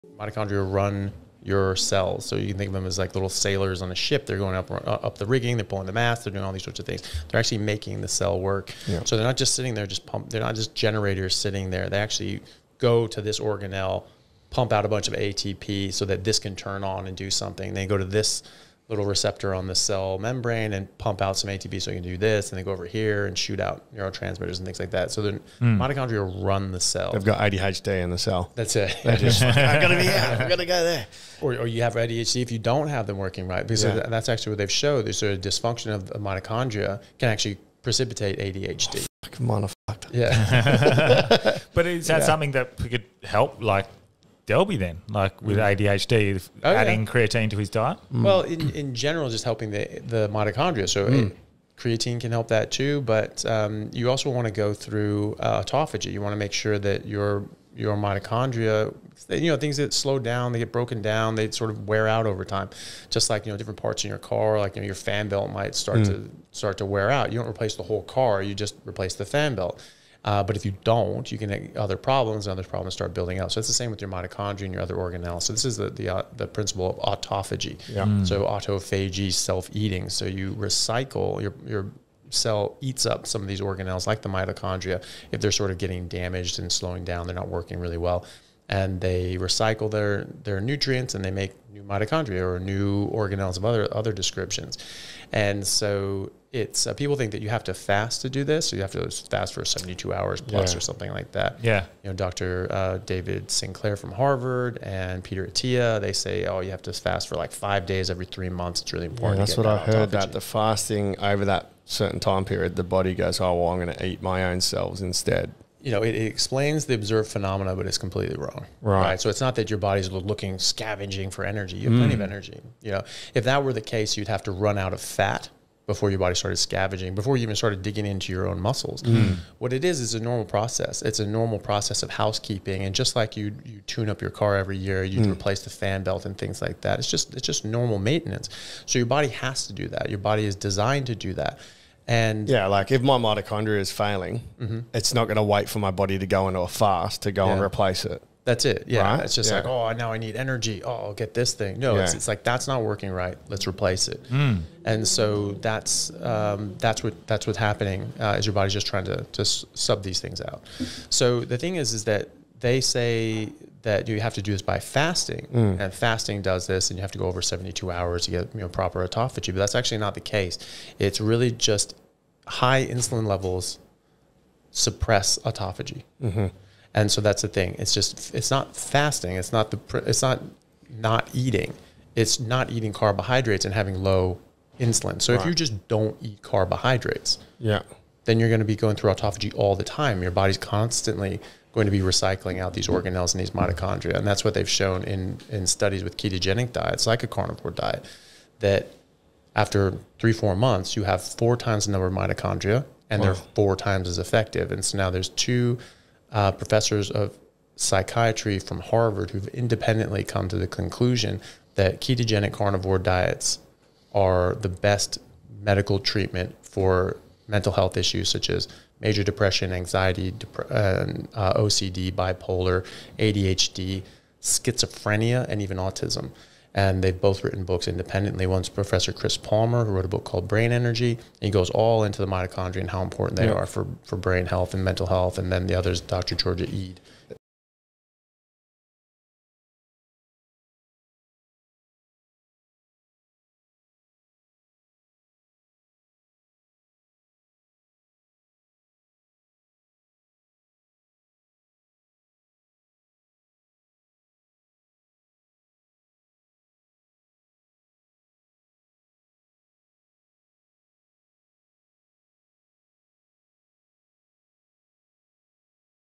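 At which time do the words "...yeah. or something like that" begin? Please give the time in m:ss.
1:40.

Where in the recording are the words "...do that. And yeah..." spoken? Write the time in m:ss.
2:21.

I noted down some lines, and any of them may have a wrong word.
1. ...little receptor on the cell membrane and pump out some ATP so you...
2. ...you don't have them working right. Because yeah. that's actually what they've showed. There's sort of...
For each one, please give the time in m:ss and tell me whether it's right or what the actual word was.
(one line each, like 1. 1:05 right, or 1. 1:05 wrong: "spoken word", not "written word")
1. 0:18 right
2. 0:32 right.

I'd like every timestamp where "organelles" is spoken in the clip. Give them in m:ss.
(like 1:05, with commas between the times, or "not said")
0:13, 1:14, 1:23, 1:33, 3:12.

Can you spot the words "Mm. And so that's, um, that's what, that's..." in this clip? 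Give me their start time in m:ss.
2:34.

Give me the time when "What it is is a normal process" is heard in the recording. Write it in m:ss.
2:09.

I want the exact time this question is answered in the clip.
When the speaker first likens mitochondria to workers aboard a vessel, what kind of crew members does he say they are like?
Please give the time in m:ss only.
0:03.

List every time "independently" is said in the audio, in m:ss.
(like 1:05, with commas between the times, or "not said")
3:29, 3:47.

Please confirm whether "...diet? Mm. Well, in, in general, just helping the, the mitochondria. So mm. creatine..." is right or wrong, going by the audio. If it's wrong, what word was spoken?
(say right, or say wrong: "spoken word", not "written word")
right.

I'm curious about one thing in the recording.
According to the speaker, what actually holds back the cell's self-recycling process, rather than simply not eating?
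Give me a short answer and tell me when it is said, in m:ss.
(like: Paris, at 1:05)
High insulin levels, at 2:52.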